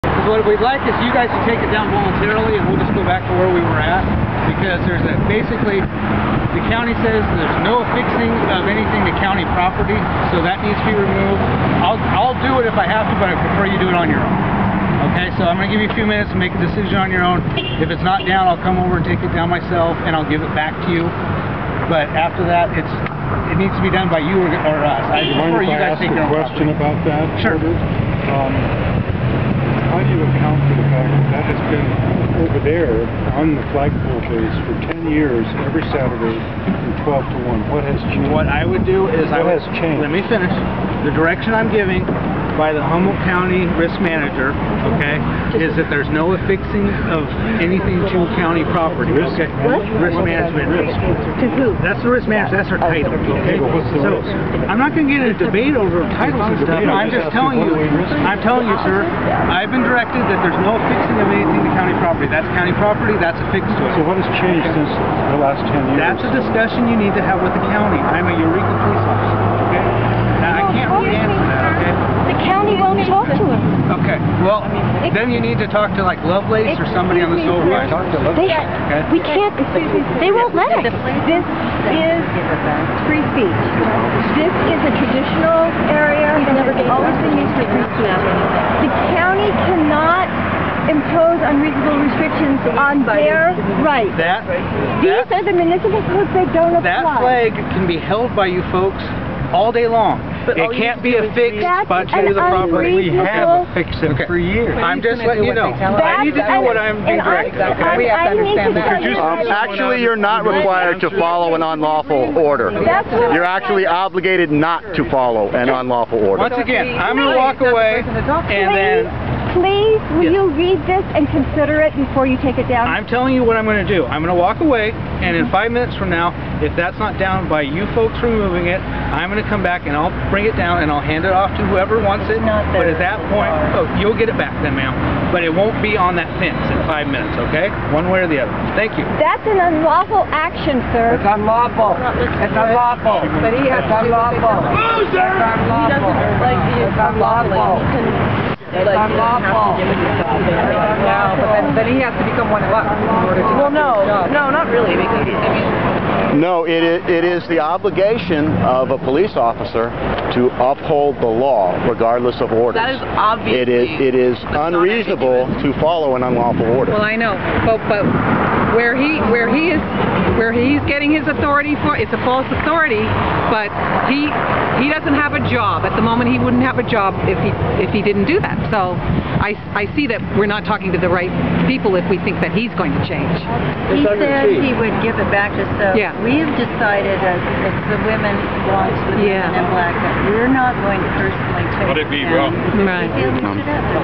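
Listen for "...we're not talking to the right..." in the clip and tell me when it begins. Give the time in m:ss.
3:00.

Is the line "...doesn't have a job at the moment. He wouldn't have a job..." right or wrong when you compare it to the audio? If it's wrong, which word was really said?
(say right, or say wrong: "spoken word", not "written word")
right.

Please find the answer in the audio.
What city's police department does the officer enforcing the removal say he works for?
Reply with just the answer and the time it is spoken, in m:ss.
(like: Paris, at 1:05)
Eureka, at 1:08.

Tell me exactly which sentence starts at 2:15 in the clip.
But it won't be on that fence in five minutes, okay?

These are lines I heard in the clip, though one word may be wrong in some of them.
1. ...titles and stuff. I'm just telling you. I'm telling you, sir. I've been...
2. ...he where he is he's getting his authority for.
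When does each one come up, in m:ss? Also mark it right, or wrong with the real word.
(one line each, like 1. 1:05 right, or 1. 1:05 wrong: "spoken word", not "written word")
1. 0:56 right
2. 2:48 right.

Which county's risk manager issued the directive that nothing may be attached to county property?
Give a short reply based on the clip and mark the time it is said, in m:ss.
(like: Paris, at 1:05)
Humboldt County, at 0:42.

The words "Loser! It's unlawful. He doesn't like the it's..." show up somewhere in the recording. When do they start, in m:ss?
2:24.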